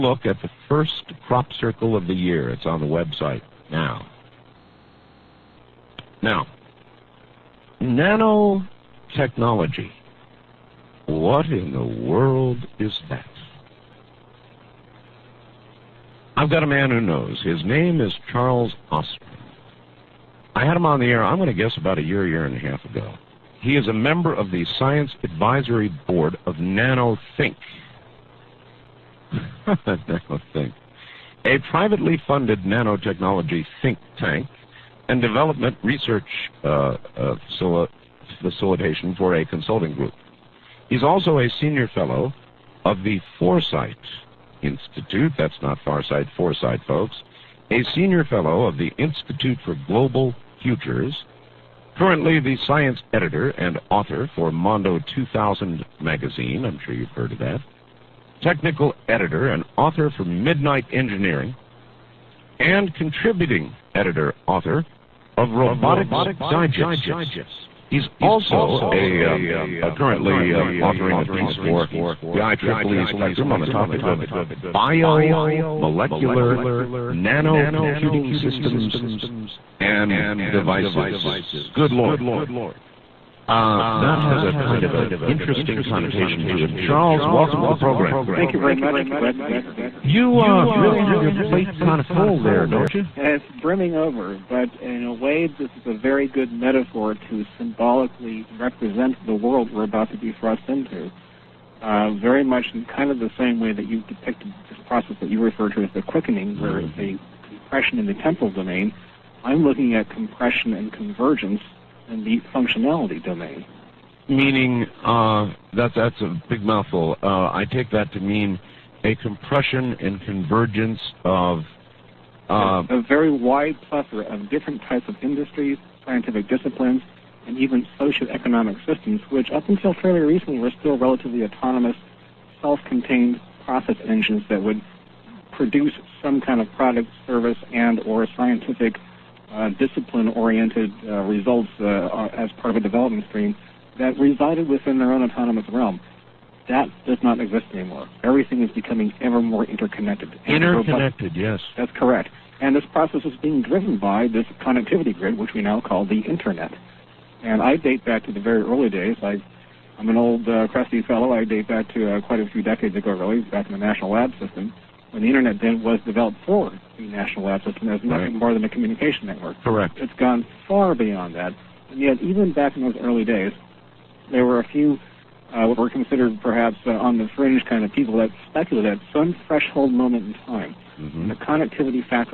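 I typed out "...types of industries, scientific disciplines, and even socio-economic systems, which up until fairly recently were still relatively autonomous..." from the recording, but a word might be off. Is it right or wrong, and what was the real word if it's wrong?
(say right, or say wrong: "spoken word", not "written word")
right.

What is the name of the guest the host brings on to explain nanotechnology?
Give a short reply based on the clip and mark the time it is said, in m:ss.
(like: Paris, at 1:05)
Charles Ostman, at 0:18.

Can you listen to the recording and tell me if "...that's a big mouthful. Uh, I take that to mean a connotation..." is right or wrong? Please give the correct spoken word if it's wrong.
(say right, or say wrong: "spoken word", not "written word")
wrong: "compression", not "connotation".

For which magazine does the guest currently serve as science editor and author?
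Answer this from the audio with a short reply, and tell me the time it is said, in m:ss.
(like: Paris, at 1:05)
Mondo 2000, at 0:54.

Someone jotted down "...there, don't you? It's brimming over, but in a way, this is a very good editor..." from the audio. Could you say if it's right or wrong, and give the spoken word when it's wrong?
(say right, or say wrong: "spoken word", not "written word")
wrong: "metaphor", not "editor".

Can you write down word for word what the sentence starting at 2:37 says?
And I date back to the very early days.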